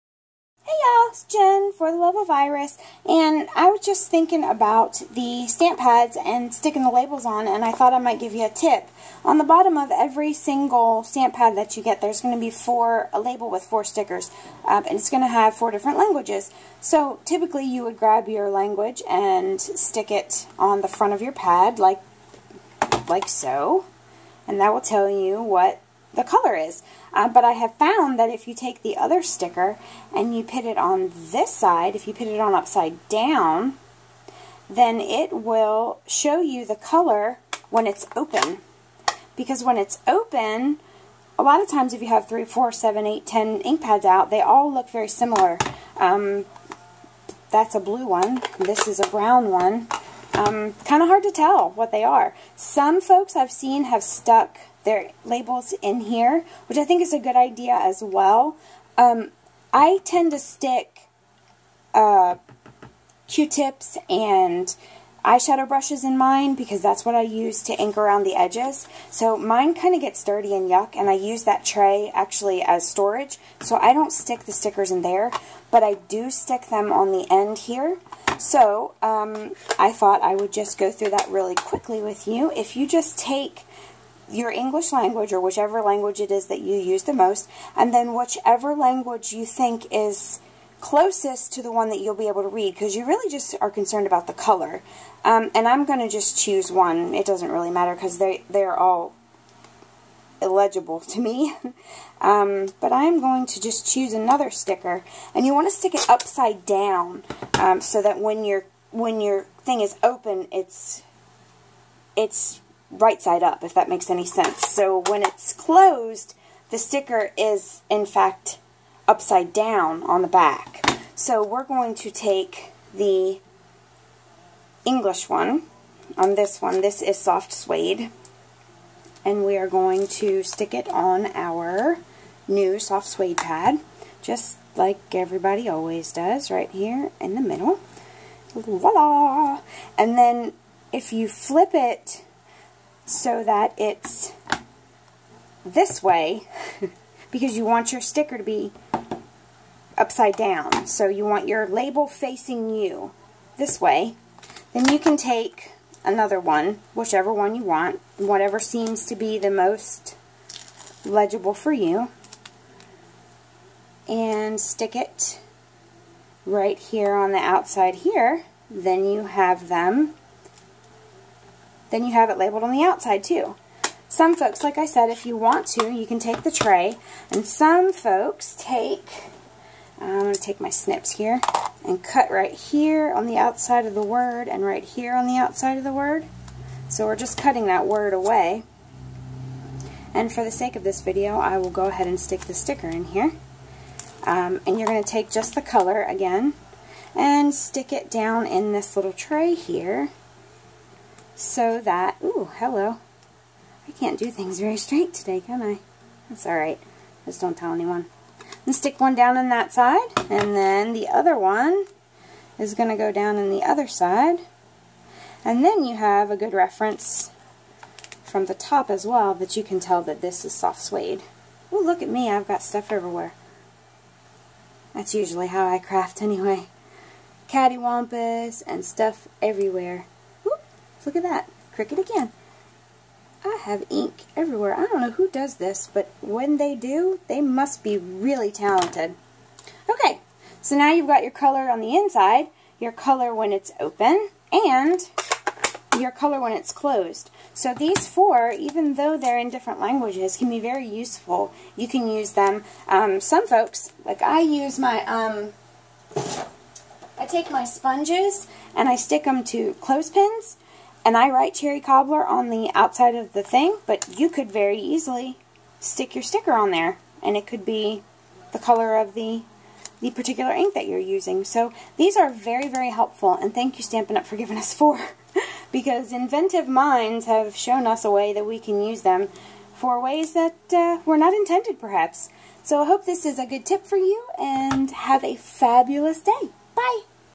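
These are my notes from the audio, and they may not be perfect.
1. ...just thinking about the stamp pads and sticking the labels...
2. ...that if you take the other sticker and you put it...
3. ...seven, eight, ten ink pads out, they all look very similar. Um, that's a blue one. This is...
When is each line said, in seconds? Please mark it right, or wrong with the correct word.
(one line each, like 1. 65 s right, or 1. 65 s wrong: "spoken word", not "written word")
1. 3 s right
2. 28 s right
3. 42 s right.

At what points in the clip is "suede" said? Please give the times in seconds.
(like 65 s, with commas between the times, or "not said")
127 s, 133 s, 220 s.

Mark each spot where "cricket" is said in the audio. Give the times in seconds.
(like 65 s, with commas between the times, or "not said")
231 s.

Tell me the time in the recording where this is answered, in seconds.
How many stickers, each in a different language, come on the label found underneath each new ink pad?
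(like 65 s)
13 s.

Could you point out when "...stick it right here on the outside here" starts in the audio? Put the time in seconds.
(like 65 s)
164 s.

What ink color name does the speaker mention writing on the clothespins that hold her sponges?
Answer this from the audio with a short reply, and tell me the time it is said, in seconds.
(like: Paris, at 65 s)
Cherry cobbler, at 261 s.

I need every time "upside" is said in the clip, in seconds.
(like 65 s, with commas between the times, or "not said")
32 s, 106 s, 119 s, 150 s.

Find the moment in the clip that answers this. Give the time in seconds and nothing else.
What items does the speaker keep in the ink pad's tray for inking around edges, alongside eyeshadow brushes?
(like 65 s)
63 s.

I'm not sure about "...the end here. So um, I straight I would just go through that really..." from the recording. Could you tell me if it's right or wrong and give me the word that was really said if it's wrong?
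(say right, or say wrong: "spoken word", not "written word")
wrong: "thought", not "straight".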